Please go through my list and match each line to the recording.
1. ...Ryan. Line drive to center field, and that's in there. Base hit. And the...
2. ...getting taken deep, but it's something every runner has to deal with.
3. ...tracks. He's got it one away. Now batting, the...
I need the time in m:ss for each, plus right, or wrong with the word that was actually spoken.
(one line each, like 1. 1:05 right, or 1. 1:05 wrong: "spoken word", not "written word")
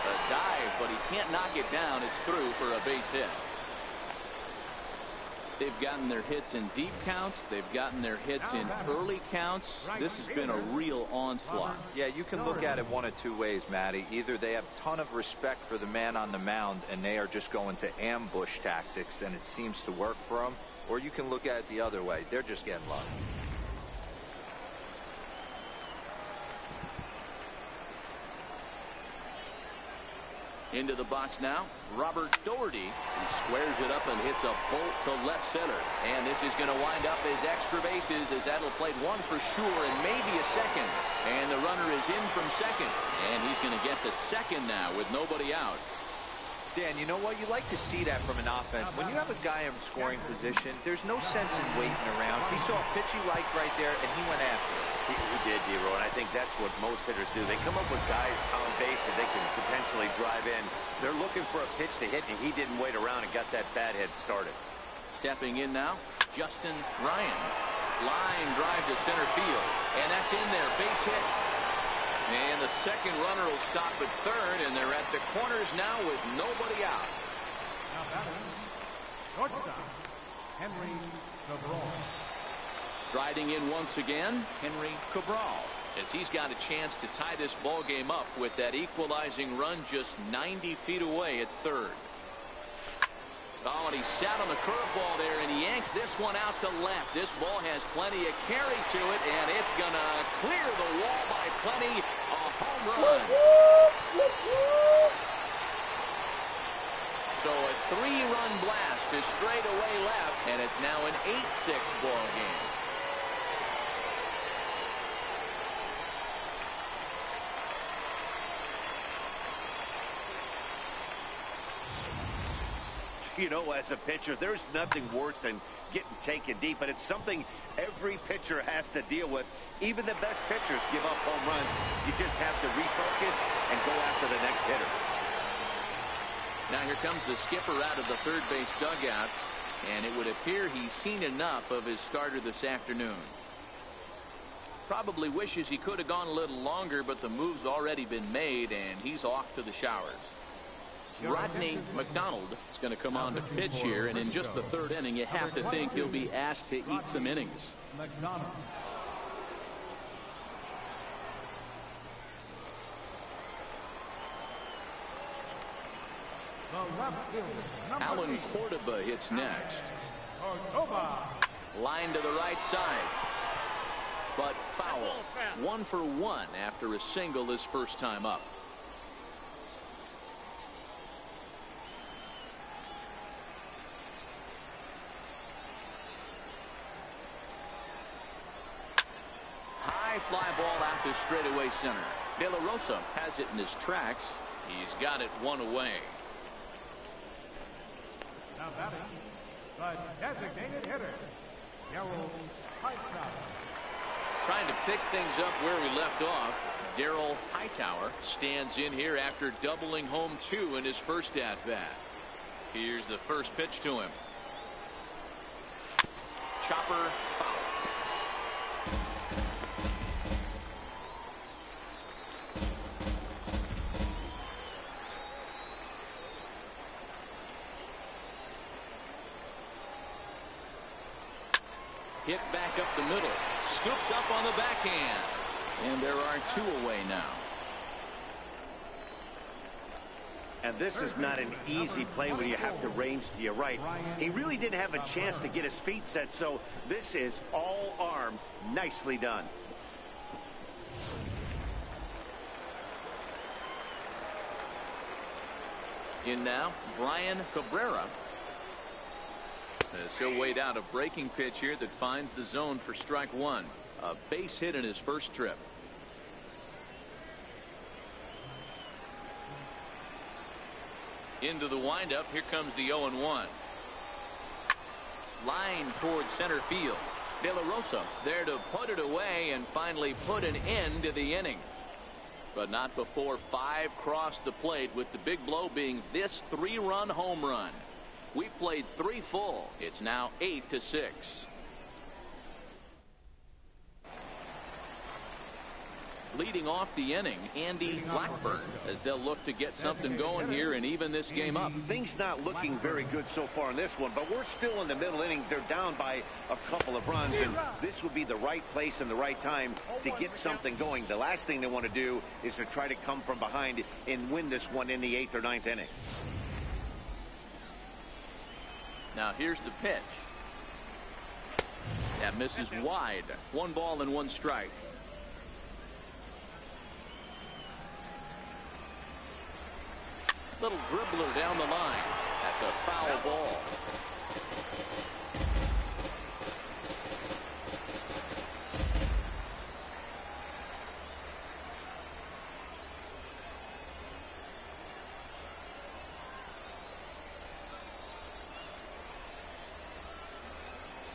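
1. 1:07 right
2. 2:05 wrong: "pitcher", not "runner"
3. 3:13 right.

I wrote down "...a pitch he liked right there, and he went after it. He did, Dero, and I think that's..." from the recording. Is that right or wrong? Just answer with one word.
right.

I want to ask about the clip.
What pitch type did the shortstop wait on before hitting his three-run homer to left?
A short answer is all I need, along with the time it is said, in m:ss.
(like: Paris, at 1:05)
curveball, at 1:34.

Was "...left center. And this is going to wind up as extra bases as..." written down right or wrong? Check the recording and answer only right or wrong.
right.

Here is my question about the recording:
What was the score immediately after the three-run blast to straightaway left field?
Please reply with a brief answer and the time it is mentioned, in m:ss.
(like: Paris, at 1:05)
8-6, at 1:51.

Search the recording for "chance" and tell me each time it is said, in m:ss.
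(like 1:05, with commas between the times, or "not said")
1:26, 4:05.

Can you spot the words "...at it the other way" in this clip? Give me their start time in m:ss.
0:21.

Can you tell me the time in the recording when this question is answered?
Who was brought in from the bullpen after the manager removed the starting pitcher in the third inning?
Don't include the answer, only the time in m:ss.
2:31.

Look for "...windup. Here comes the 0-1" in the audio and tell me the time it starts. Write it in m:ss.
4:31.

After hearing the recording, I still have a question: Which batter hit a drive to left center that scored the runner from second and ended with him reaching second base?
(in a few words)
Robert Doherty.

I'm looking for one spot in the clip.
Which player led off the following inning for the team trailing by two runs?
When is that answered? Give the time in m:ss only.
4:57.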